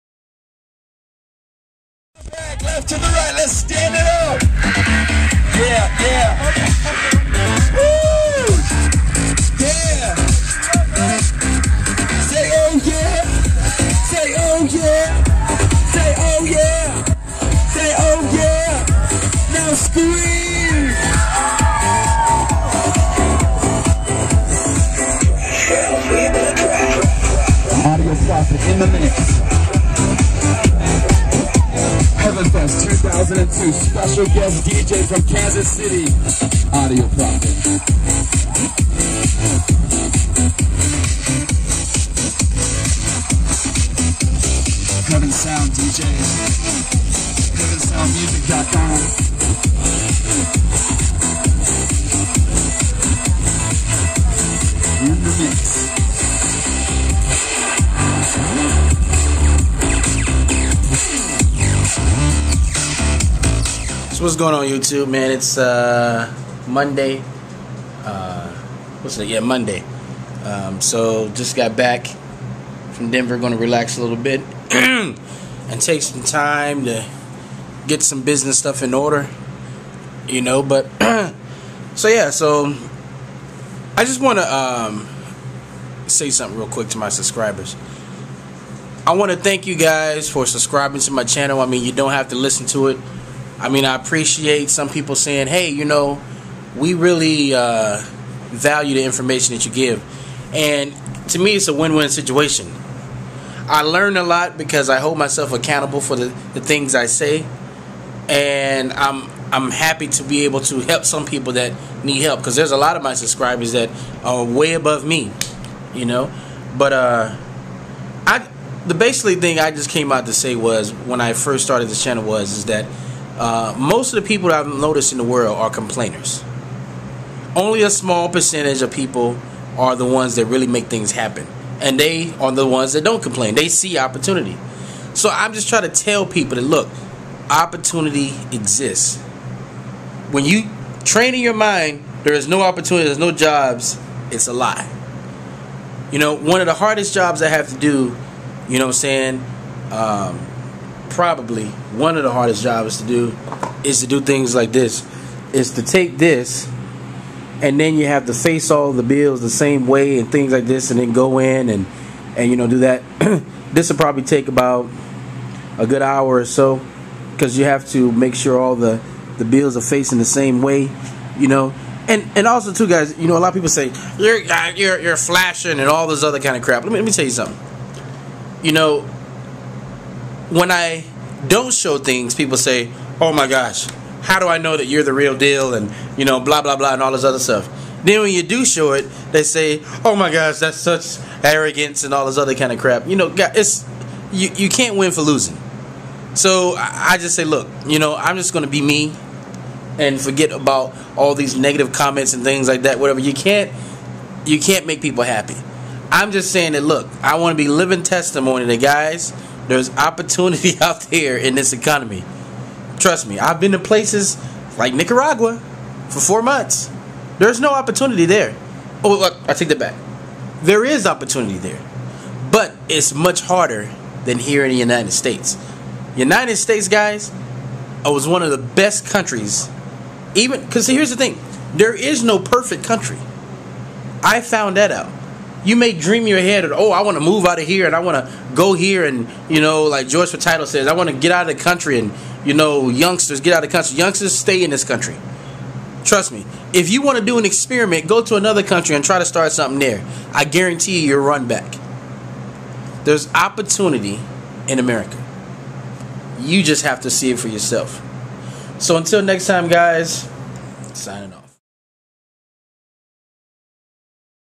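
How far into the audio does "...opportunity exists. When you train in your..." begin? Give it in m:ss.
2:17.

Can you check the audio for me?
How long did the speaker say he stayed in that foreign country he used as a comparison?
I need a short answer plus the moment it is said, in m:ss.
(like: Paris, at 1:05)
4 months, at 3:36.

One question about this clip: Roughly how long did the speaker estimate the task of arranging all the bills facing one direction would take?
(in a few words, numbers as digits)
1 hour.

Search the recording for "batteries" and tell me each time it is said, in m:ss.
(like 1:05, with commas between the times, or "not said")
not said.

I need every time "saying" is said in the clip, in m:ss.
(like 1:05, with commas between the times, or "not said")
1:35, 2:28, 3:26.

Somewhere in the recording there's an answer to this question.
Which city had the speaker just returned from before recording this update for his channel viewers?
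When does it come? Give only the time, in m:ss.
1:13.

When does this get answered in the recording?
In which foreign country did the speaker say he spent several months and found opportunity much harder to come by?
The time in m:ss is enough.
3:34.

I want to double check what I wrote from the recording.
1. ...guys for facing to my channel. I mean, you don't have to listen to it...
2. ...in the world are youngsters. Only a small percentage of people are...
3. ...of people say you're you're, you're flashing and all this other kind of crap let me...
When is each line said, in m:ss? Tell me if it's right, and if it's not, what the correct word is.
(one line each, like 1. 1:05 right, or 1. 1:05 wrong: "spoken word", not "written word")
1. 1:29 wrong: "subscribing", not "facing"
2. 2:05 wrong: "complainers", not "youngsters"
3. 2:53 right.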